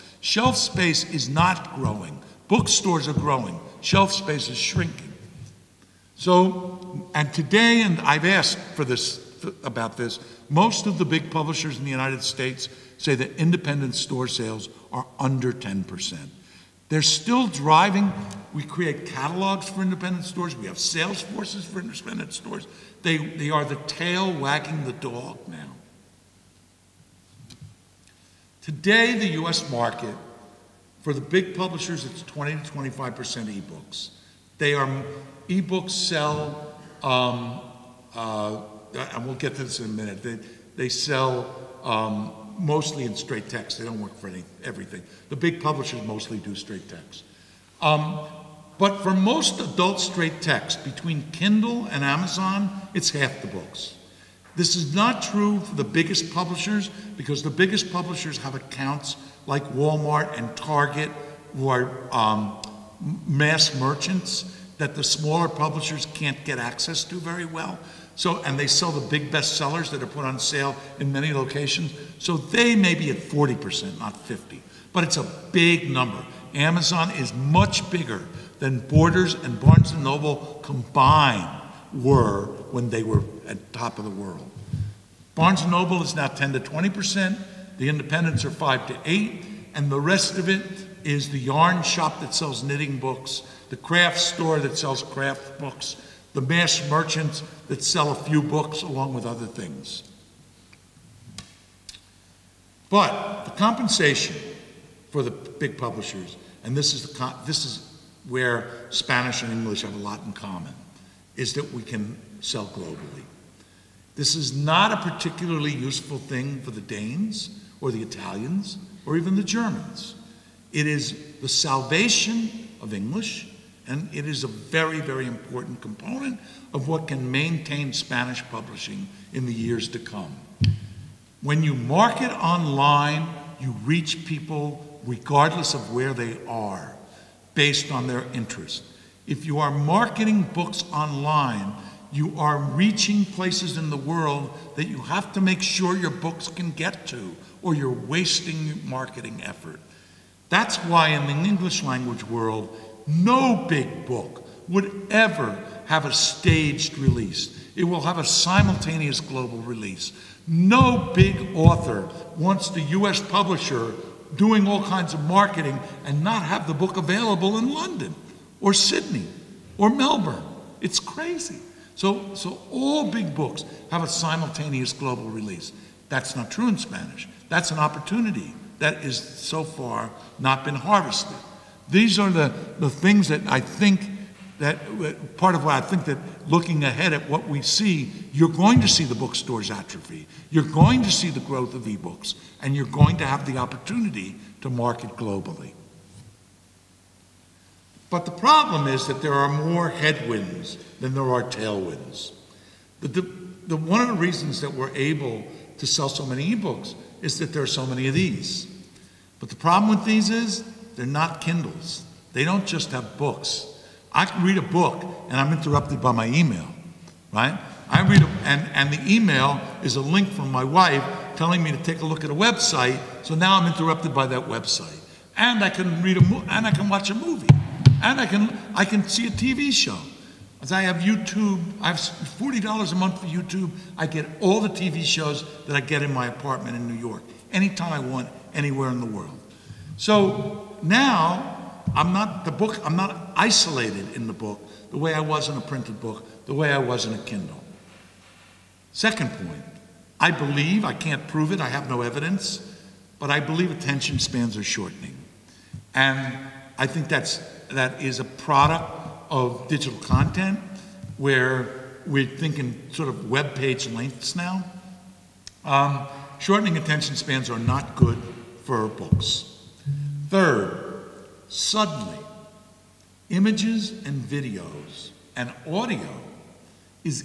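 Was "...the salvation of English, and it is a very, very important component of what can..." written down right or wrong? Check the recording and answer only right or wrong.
right.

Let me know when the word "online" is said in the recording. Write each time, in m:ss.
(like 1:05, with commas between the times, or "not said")
2:12, 2:20.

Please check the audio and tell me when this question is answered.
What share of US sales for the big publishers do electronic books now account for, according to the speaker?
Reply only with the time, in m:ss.
0:32.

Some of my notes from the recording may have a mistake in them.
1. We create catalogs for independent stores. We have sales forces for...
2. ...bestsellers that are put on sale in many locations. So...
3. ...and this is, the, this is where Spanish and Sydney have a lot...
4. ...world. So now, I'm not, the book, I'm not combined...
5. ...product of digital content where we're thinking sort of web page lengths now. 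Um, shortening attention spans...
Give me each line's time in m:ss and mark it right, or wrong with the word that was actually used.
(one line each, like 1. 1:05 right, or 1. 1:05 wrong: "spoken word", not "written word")
1. 0:18 right
2. 1:09 right
3. 1:46 wrong: "English", not "Sydney"
4. 3:59 wrong: "isolated", not "combined"
5. 4:18 right.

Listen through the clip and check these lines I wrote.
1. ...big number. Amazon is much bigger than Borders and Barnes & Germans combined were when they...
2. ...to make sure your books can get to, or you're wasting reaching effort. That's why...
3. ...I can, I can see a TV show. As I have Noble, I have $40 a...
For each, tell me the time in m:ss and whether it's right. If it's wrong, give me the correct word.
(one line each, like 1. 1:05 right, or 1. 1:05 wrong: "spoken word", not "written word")
1. 1:15 wrong: "Noble", not "Germans"
2. 2:25 wrong: "marketing", not "reaching"
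3. 3:48 wrong: "YouTube", not "Noble".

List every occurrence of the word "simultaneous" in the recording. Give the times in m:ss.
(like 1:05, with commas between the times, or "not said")
2:38, 2:54.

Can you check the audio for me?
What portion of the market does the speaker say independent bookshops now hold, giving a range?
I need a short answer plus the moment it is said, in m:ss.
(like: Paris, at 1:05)
5 to 8, at 1:28.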